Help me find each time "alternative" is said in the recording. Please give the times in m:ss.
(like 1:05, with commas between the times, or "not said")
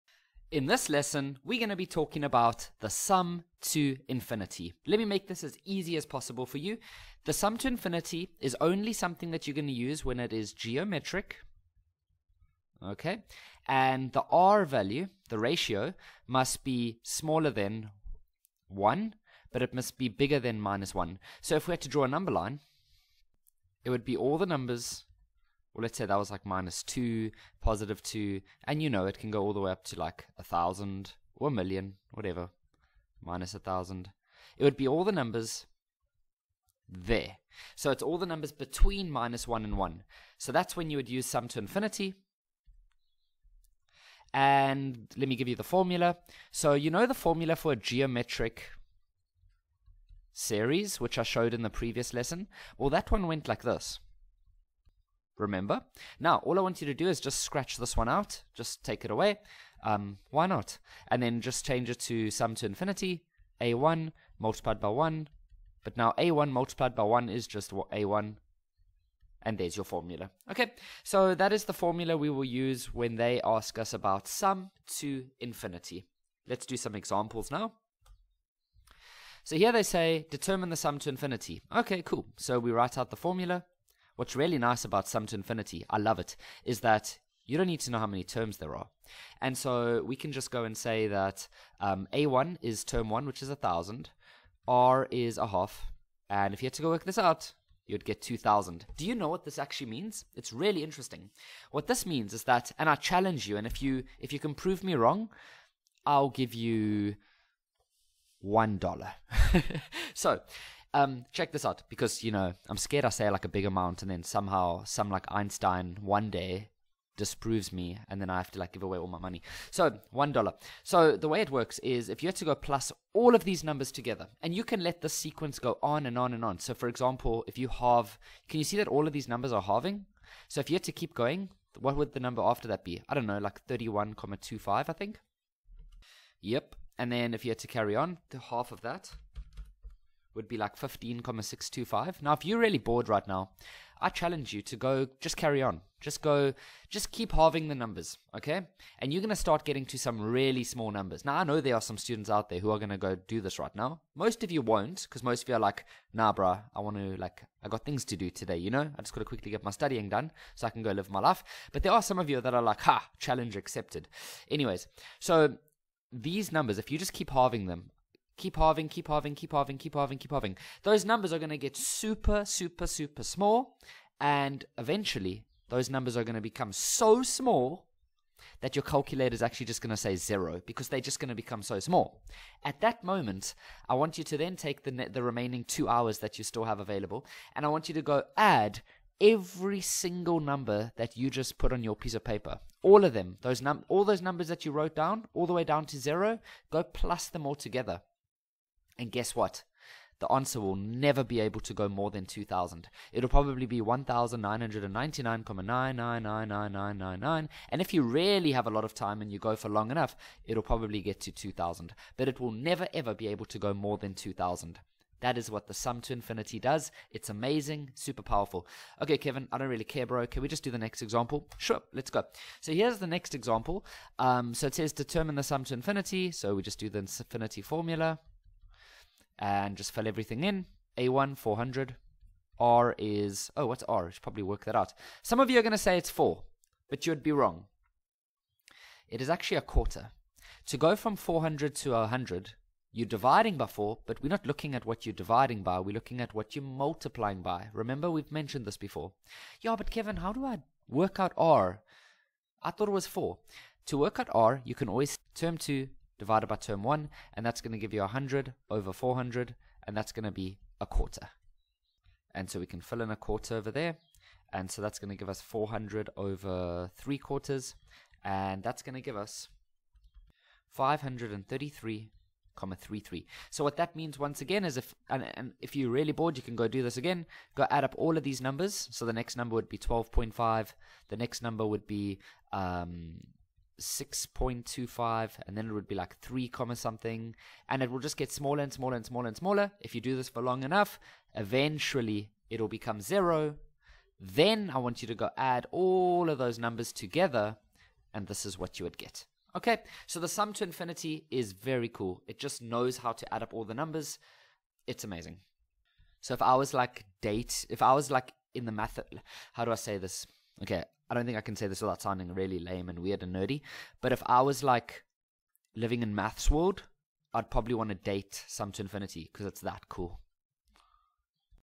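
not said.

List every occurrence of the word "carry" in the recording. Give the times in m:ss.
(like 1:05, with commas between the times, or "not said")
2:17, 2:25.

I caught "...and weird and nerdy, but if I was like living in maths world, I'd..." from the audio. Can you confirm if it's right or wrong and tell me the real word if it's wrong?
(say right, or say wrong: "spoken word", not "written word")
right.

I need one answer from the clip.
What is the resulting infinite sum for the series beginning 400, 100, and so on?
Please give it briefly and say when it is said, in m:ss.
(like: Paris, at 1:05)
533.33, at 4:30.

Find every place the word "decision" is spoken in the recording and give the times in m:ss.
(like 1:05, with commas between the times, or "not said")
not said.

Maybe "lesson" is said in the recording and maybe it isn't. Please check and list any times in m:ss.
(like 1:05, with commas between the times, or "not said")
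0:00, 0:52.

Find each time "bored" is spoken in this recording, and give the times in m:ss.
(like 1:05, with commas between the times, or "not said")
2:22, 4:36.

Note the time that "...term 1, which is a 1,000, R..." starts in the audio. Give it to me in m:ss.
1:32.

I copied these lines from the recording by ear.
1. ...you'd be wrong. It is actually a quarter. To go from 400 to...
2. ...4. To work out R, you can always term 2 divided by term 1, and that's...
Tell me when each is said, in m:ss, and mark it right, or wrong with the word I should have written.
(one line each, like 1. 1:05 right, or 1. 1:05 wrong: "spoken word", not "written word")
1. 3:57 right
2. 4:13 right.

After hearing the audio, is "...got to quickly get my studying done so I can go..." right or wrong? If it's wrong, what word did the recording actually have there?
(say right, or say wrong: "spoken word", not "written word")
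right.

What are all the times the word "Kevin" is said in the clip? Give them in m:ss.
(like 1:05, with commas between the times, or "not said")
3:39, 4:09.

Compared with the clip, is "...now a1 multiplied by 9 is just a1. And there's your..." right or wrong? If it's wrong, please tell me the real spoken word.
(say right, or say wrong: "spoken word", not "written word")
wrong: "1", not "9".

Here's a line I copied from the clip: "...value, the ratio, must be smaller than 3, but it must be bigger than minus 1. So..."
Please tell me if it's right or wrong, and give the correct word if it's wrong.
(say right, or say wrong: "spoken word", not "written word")
wrong: "1", not "3".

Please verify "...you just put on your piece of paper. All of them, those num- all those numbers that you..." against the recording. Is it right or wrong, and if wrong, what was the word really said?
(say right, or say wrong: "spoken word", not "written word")
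right.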